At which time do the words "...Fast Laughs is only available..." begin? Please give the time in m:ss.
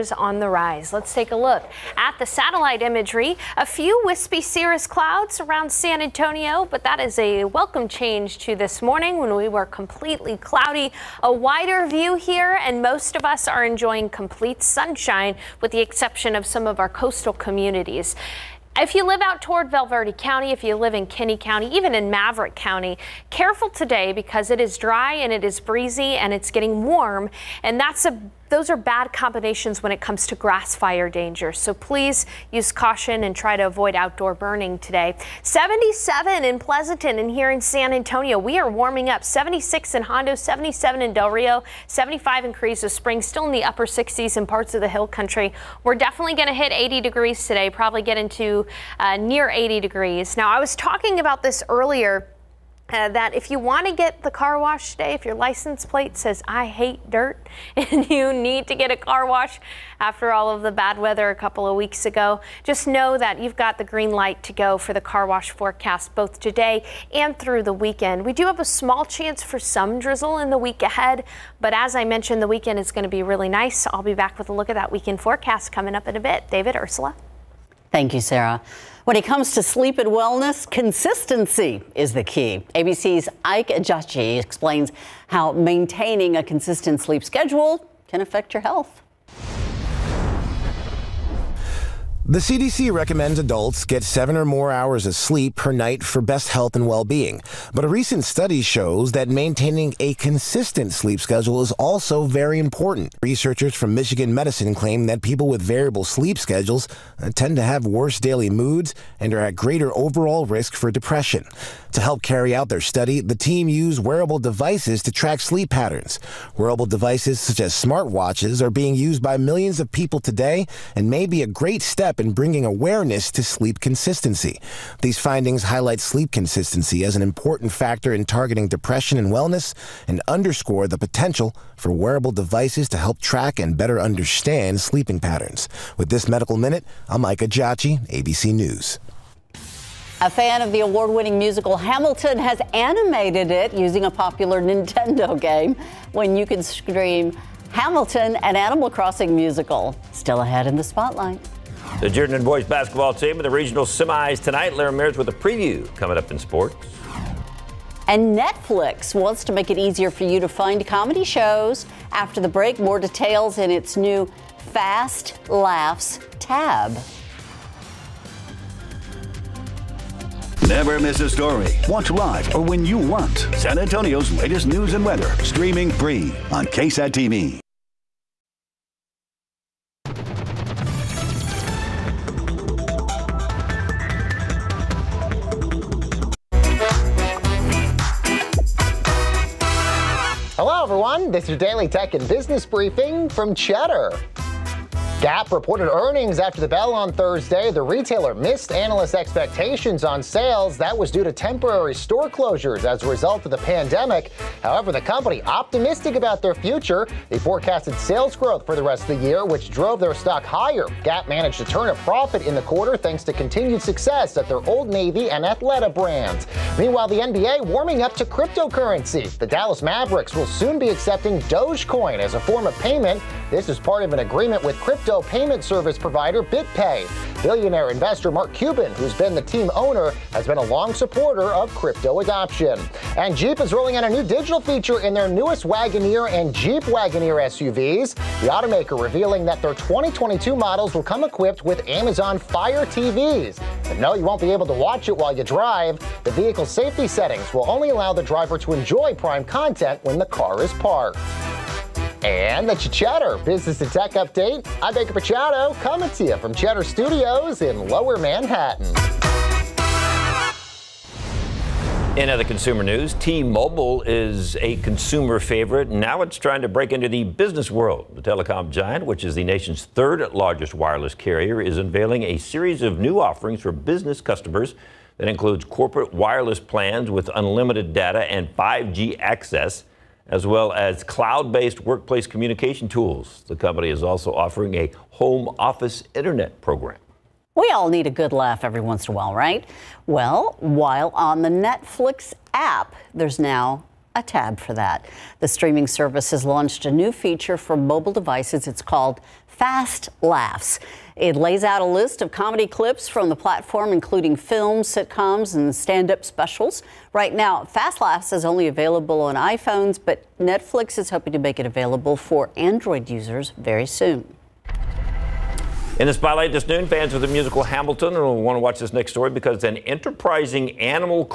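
5:07.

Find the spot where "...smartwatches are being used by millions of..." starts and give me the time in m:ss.
1:57.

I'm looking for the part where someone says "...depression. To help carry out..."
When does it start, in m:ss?
1:50.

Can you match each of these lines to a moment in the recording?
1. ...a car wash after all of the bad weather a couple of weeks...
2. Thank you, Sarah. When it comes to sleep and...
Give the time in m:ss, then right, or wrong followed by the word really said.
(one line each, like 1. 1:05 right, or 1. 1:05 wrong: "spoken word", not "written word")
1. 0:58 right
2. 1:17 right.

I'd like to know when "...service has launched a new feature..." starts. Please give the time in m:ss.
4:55.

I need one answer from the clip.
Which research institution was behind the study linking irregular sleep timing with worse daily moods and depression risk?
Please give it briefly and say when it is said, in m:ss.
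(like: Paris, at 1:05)
Michigan Medicine, at 1:43.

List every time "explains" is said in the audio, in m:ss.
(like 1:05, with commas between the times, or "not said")
1:24.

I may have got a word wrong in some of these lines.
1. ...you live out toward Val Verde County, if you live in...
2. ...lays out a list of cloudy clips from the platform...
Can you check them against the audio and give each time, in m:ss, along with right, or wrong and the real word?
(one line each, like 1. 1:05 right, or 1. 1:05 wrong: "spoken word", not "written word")
1. 0:18 right
2. 5:01 wrong: "comedy", not "cloudy".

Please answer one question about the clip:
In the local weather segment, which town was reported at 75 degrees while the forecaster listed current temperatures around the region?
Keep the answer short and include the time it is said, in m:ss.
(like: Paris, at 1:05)
Carrizo Springs, at 0:42.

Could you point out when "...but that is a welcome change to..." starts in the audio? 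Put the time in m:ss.
0:06.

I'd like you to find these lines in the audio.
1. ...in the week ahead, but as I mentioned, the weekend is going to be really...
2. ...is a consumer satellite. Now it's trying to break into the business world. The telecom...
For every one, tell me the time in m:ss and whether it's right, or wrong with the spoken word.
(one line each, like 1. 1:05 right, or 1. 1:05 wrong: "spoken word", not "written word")
1. 1:10 right
2. 4:24 wrong: "favorite", not "satellite".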